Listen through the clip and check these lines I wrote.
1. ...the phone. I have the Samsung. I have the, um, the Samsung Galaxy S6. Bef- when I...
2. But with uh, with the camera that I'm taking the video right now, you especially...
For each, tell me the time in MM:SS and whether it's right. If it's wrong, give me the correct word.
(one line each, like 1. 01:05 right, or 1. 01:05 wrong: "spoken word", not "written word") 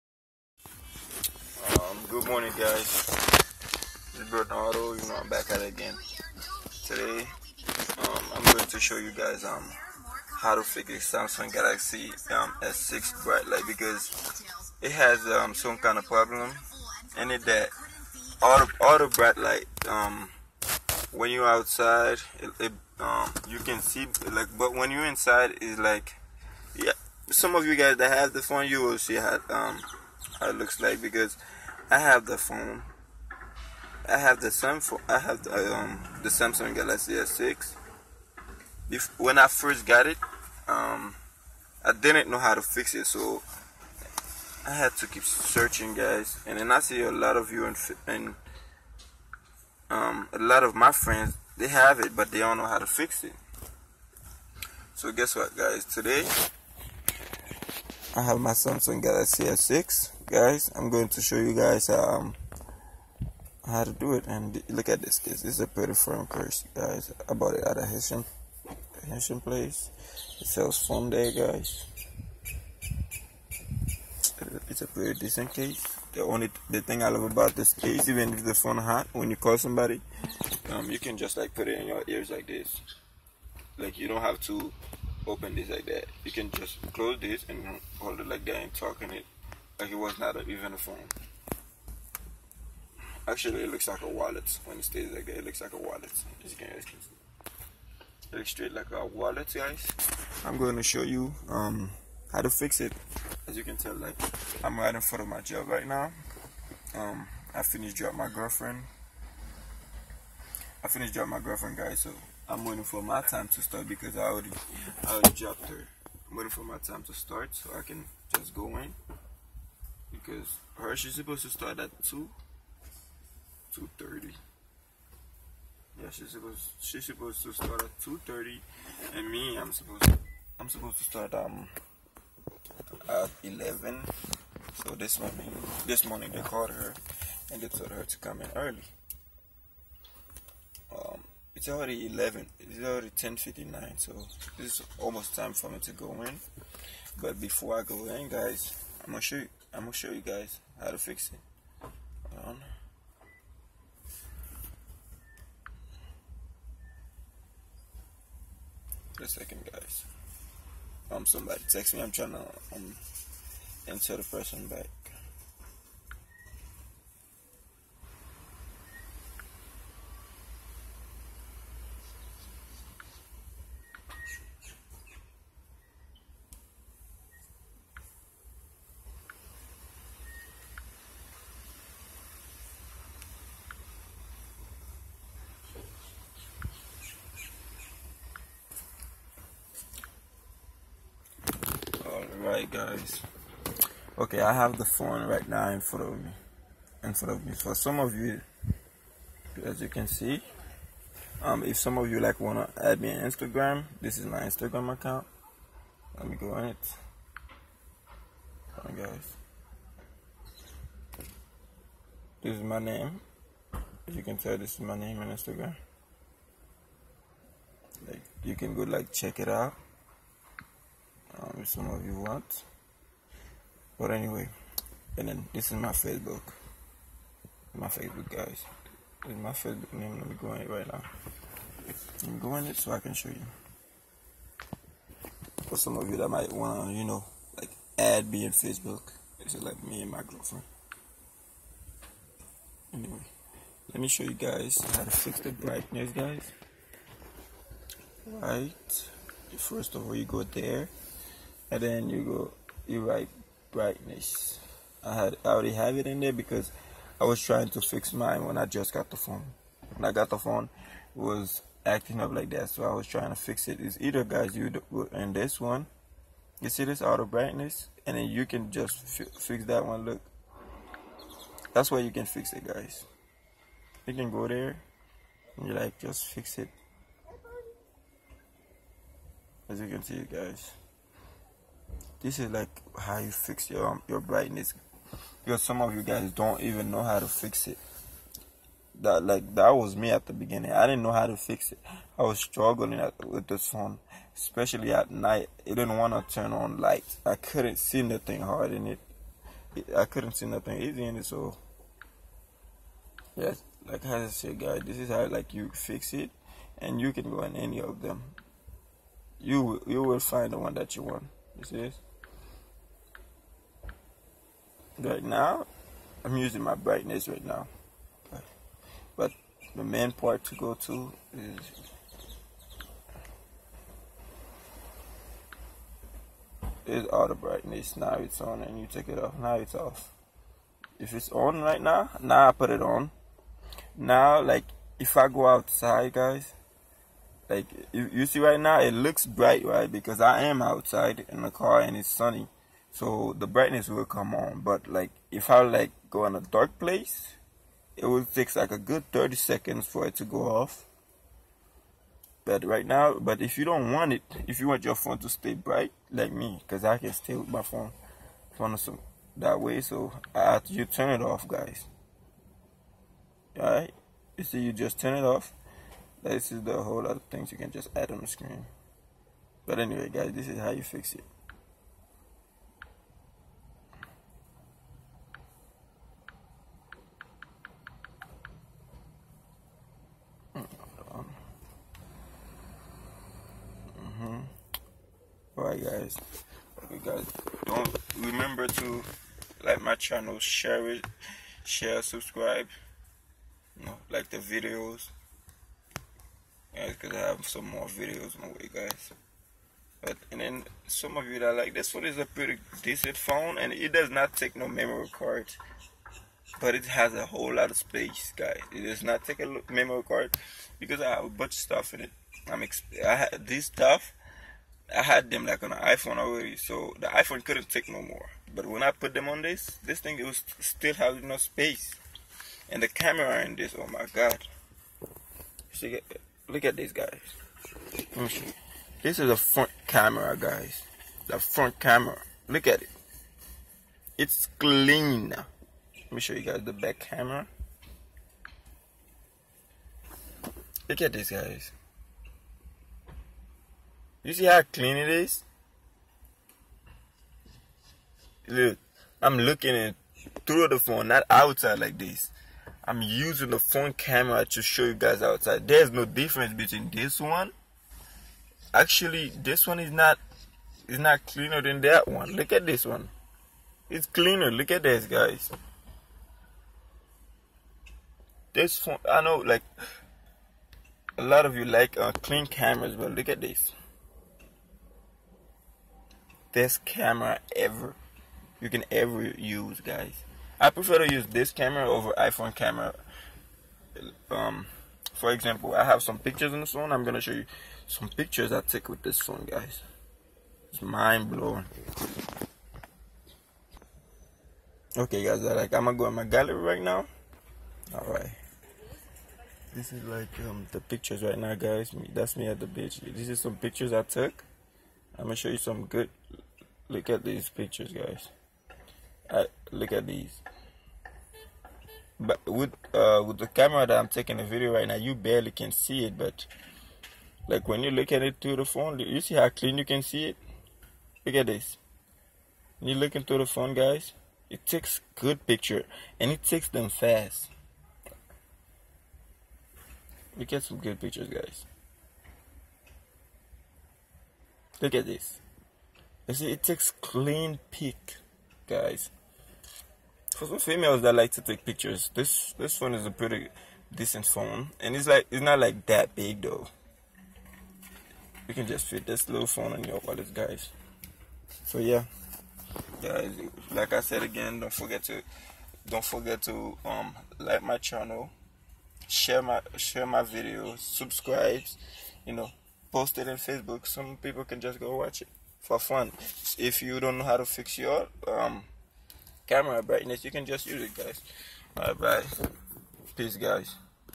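1. 00:32 right
2. 08:32 wrong: "barely", not "especially".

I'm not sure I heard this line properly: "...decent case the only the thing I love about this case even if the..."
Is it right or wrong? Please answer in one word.
right.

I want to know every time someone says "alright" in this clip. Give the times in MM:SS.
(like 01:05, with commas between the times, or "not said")
06:03, 09:31.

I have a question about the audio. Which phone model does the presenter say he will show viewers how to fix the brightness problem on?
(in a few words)
Samsung Galaxy S6.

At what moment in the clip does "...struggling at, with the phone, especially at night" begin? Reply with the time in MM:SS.
04:52.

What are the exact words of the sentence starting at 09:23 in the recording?
Some people can just go watch it for fun.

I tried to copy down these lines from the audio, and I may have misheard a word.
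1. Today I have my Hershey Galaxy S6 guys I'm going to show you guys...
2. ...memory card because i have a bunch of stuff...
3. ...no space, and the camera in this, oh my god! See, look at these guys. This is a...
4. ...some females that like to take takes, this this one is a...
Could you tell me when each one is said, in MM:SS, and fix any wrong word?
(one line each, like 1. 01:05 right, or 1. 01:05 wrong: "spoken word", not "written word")
1. 00:55 wrong: "Samsung", not "Hershey"
2. 06:49 right
3. 07:01 right
4. 09:00 wrong: "pictures", not "takes".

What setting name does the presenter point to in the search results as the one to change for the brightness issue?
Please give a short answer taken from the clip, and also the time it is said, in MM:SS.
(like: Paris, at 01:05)
Auto brightness, at 04:27.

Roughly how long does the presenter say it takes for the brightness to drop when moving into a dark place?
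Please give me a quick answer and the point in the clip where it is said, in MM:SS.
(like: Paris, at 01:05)
30 seconds, at 05:49.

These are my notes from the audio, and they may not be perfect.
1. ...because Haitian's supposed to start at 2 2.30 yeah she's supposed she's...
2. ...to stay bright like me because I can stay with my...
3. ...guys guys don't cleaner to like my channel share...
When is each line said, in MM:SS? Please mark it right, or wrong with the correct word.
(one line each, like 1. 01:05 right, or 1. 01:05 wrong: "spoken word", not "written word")
1. 02:00 wrong: "Hershey", not "Haitian"
2. 05:55 right
3. 06:25 wrong: "remember", not "cleaner".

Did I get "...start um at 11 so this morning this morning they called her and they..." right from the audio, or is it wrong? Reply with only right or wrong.
right.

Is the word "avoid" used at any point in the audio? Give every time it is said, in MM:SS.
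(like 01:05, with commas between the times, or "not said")
not said.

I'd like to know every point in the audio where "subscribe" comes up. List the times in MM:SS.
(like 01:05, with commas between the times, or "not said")
06:32, 09:20.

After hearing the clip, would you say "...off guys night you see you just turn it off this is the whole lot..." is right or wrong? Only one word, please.
wrong.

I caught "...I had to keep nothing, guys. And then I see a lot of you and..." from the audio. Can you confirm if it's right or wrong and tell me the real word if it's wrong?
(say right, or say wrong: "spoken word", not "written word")
wrong: "searching", not "nothing".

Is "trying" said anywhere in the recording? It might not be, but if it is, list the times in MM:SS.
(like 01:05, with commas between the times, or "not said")
02:42, 04:17, 04:23.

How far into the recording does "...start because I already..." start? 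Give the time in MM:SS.
01:53.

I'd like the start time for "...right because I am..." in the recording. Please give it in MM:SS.
05:39.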